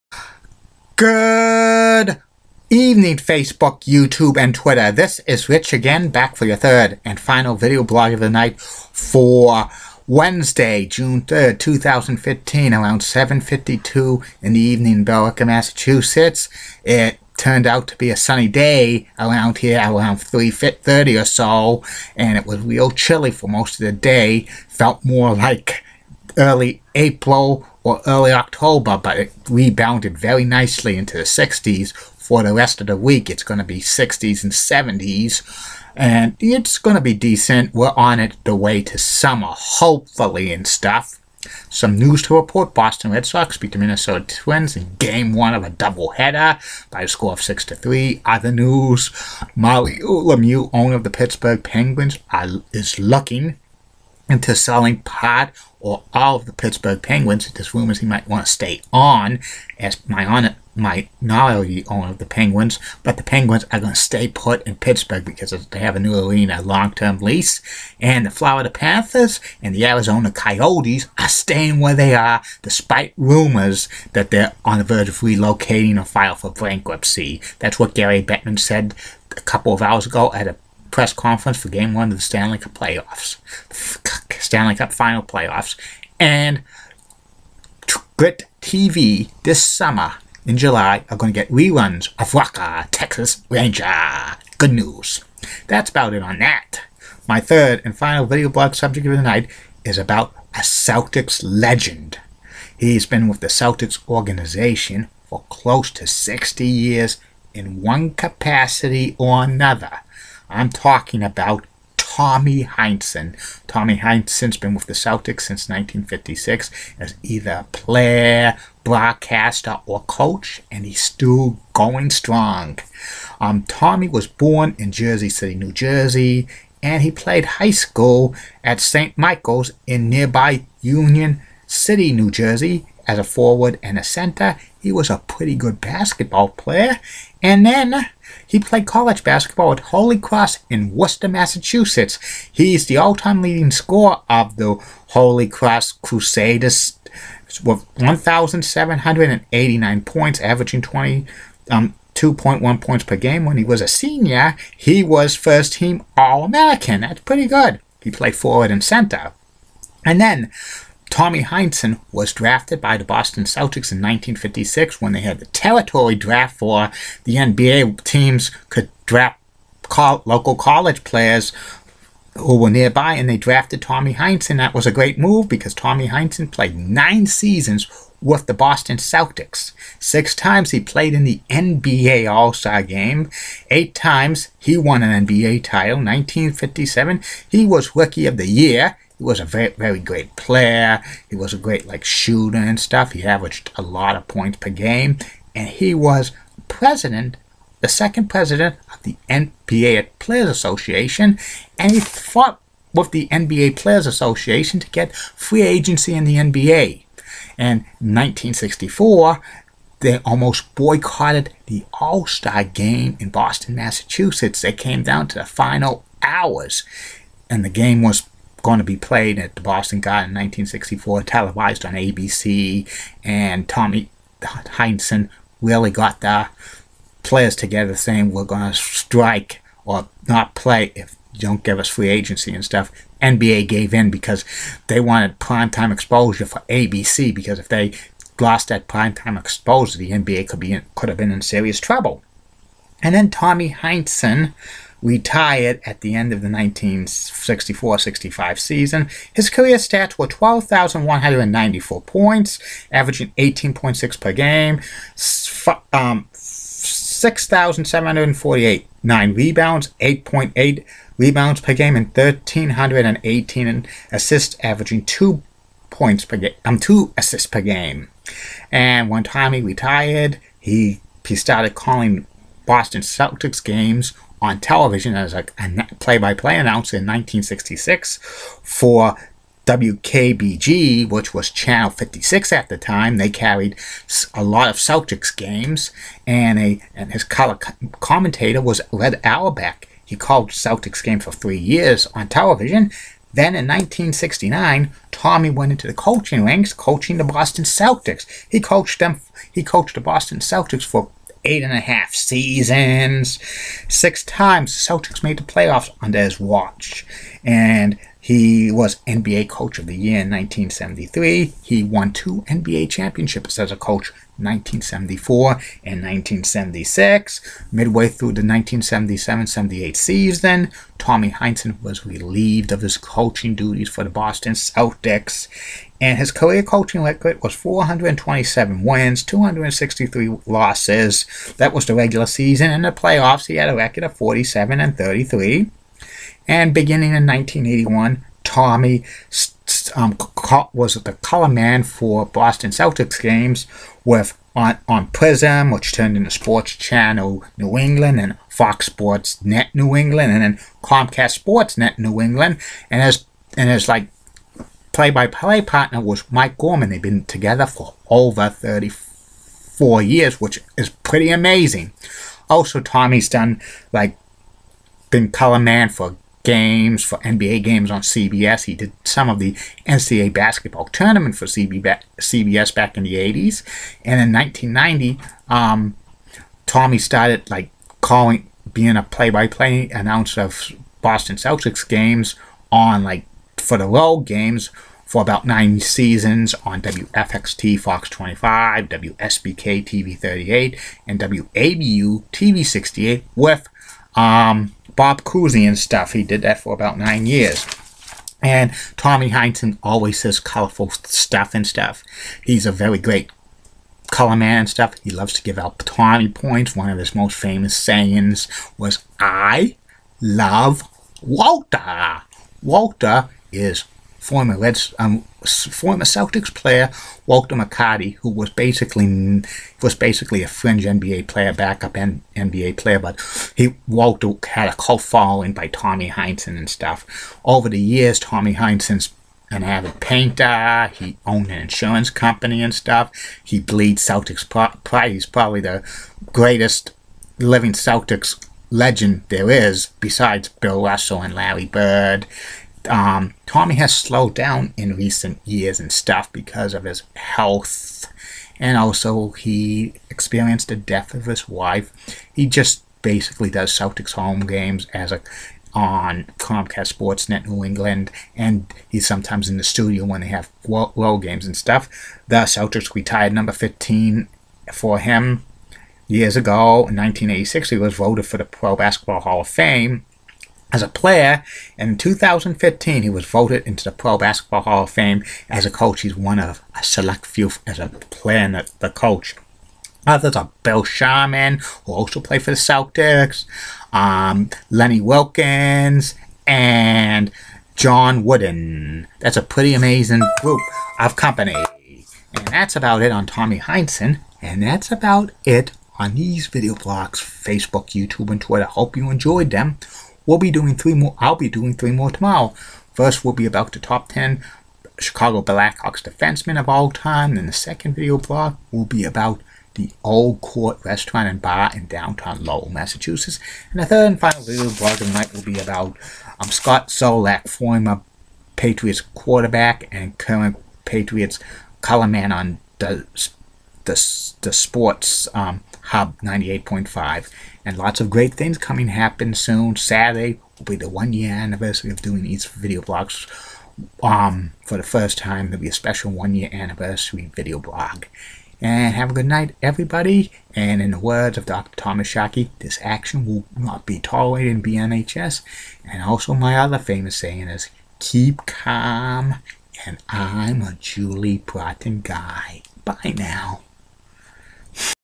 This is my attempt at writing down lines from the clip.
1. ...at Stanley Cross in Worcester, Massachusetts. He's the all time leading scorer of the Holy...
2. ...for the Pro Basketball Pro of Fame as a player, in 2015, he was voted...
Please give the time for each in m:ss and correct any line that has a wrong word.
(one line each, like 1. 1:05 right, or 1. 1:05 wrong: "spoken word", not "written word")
1. 2:19 wrong: "Holy", not "Stanley"
2. 7:48 wrong: "Hall", not "Pro".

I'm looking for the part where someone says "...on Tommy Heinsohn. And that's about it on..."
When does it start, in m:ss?
8:13.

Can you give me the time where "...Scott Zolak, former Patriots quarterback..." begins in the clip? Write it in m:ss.
8:36.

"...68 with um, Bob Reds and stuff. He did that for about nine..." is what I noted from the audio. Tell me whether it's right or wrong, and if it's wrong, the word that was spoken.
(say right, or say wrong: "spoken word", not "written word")
wrong: "Cousy", not "Reds".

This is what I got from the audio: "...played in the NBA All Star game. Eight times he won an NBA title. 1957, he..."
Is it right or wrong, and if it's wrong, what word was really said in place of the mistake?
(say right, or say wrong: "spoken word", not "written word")
right.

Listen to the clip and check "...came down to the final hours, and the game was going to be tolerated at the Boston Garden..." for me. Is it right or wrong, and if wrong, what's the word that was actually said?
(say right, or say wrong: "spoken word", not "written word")
wrong: "played", not "tolerated".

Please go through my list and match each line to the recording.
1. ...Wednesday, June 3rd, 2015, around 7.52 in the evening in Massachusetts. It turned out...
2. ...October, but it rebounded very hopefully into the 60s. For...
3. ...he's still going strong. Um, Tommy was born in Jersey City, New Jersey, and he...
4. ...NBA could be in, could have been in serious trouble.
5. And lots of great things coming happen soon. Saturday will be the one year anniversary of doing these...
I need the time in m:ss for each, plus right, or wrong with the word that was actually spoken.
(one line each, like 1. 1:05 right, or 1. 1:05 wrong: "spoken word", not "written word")
1. 0:10 right
2. 0:28 wrong: "nicely", not "hopefully"
3. 2:00 right
4. 4:00 right
5. 8:47 right.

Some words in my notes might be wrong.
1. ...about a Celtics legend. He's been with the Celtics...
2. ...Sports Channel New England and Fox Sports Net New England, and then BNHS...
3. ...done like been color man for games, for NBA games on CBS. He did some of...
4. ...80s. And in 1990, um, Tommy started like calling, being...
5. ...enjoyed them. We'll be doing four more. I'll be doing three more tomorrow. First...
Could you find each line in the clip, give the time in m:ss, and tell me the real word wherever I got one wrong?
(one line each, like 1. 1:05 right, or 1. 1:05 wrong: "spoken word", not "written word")
1. 1:39 right
2. 5:46 wrong: "Comcast", not "BNHS"
3. 6:03 right
4. 6:13 right
5. 8:19 wrong: "three", not "four".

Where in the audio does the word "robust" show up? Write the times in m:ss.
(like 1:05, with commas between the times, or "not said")
not said.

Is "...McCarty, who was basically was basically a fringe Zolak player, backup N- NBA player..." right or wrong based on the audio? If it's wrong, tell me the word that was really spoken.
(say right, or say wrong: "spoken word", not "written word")
wrong: "NBA", not "Zolak".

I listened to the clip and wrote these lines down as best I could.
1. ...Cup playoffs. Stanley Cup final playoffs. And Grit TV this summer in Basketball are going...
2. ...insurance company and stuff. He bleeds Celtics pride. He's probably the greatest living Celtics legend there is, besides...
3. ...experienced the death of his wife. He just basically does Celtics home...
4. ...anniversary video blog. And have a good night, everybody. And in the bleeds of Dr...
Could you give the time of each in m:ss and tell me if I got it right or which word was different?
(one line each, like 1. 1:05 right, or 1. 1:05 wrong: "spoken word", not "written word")
1. 1:22 wrong: "July", not "Basketball"
2. 7:11 right
3. 7:30 right
4. 8:56 wrong: "words", not "bleeds".